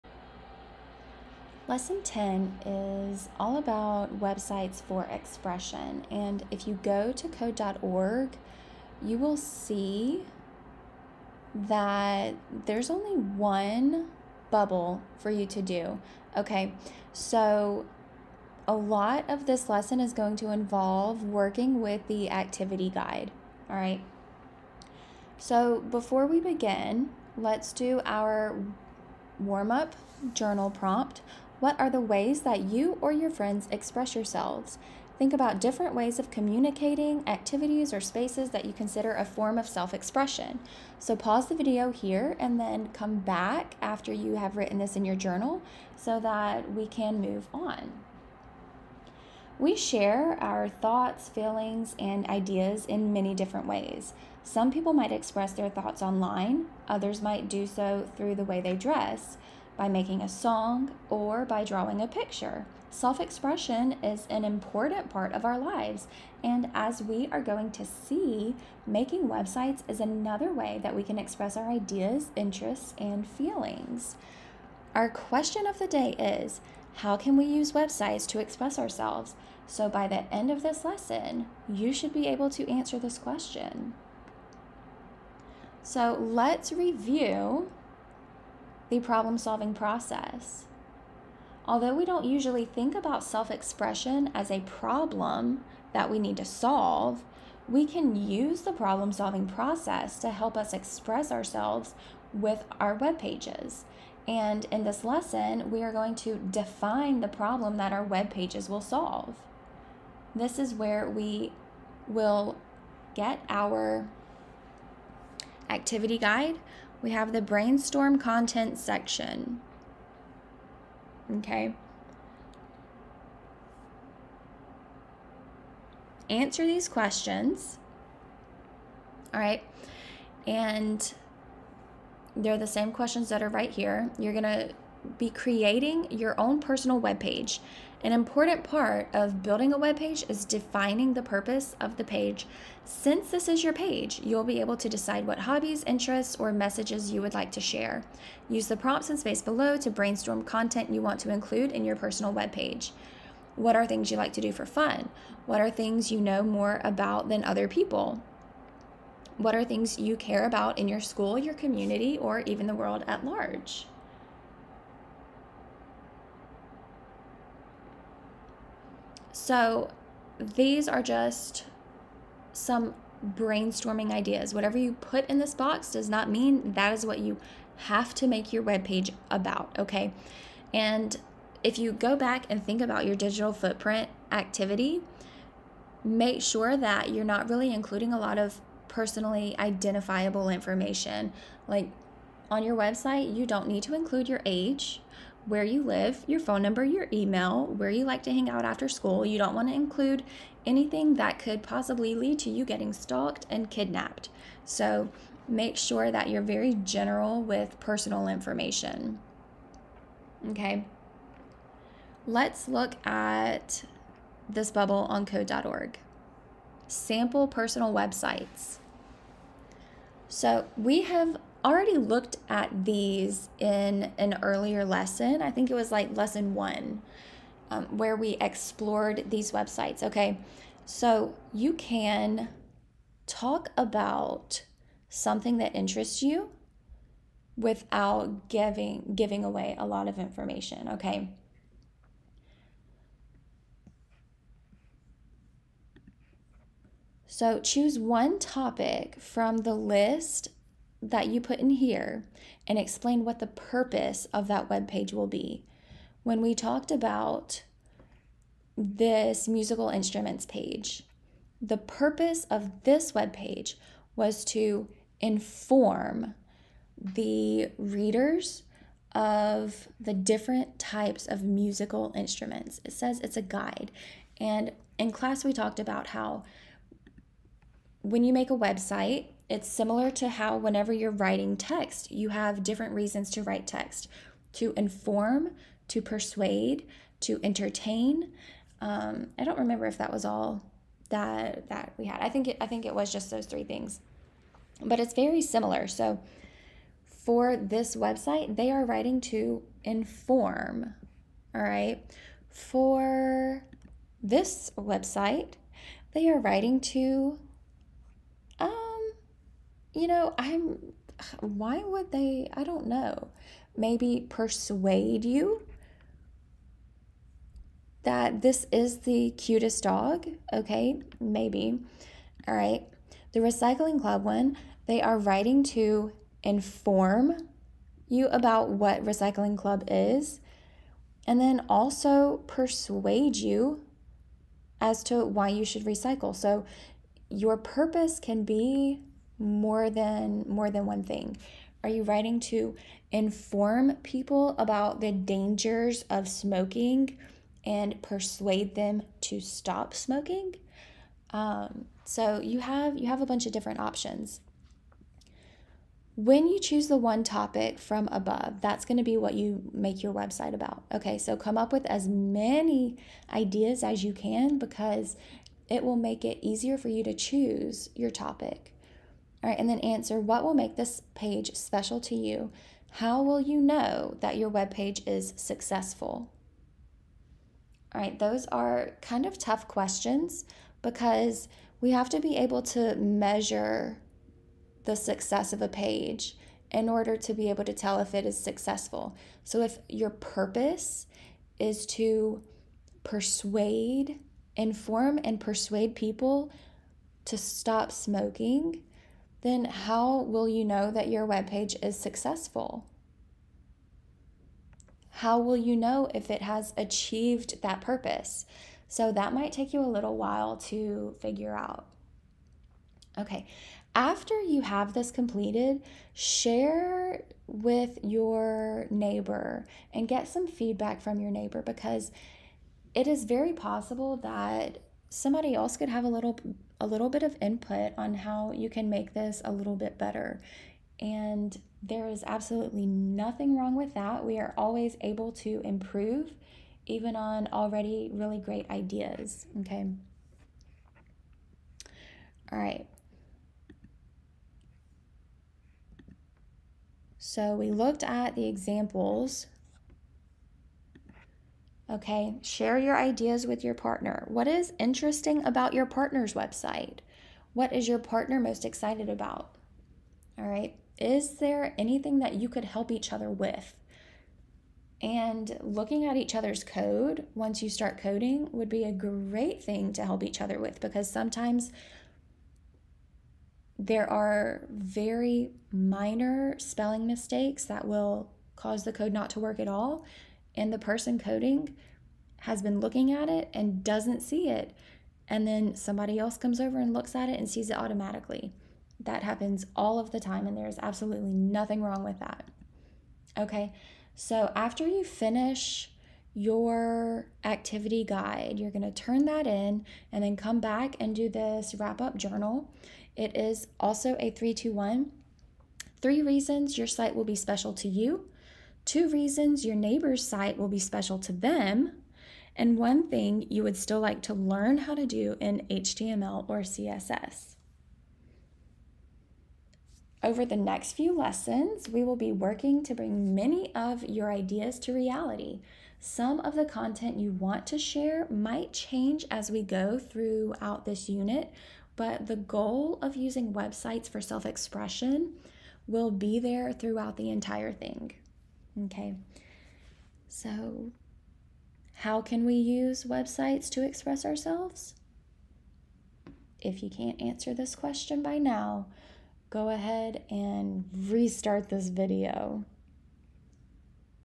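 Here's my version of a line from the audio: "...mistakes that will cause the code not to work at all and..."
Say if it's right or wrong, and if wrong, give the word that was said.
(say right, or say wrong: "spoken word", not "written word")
right.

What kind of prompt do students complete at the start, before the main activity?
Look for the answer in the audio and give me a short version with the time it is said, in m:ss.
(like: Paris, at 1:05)
warm up journal prompt, at 0:29.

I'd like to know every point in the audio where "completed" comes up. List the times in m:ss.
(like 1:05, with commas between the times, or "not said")
6:55.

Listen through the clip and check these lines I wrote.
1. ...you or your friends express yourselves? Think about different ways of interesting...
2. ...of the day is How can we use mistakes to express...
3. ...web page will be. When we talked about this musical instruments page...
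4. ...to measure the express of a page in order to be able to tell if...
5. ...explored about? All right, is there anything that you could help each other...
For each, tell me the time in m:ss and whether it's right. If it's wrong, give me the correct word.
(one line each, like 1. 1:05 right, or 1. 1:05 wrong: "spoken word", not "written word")
1. 0:32 wrong: "communicating", not "interesting"
2. 1:15 wrong: "websites", not "mistakes"
3. 4:14 right
4. 6:22 wrong: "success", not "express"
5. 7:38 wrong: "excited", not "explored".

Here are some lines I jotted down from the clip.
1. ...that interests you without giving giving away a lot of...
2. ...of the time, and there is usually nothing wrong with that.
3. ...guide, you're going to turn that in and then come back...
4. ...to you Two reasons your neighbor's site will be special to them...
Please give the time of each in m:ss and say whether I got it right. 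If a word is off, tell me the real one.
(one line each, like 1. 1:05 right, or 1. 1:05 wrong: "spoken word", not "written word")
1. 3:55 right
2. 8:09 wrong: "absolutely", not "usually"
3. 8:18 right
4. 8:27 right.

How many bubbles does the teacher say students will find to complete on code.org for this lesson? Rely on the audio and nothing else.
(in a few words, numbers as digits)
1.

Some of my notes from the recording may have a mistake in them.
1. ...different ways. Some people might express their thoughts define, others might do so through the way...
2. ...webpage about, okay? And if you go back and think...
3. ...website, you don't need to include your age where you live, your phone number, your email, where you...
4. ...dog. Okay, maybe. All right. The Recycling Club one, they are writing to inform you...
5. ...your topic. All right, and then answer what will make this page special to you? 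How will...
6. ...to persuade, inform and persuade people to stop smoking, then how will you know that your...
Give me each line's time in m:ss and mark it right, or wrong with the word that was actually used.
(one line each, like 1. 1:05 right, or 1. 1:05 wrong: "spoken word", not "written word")
1. 0:53 wrong: "online", not "define"
2. 2:58 right
3. 3:12 right
4. 5:19 right
5. 6:07 right
6. 6:31 right.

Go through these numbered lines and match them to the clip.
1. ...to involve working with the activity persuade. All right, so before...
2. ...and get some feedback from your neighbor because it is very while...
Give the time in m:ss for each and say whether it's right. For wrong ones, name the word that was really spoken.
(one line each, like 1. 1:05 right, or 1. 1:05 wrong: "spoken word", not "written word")
1. 0:20 wrong: "guide", not "persuade"
2. 6:59 wrong: "possible", not "while".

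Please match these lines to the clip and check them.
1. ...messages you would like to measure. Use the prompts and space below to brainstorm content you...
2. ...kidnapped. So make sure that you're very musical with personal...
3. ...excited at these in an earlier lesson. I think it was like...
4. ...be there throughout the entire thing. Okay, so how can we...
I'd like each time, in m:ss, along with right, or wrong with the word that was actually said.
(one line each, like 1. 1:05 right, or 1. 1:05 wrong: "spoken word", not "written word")
1. 2:26 wrong: "share", not "measure"
2. 3:23 wrong: "general", not "musical"
3. 3:41 wrong: "looked", not "excited"
4. 8:56 right.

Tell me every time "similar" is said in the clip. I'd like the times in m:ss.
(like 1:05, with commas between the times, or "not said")
4:39, 4:55.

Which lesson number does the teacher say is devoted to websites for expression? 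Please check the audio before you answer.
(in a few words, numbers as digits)
10.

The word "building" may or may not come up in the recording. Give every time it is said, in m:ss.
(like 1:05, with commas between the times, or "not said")
2:19.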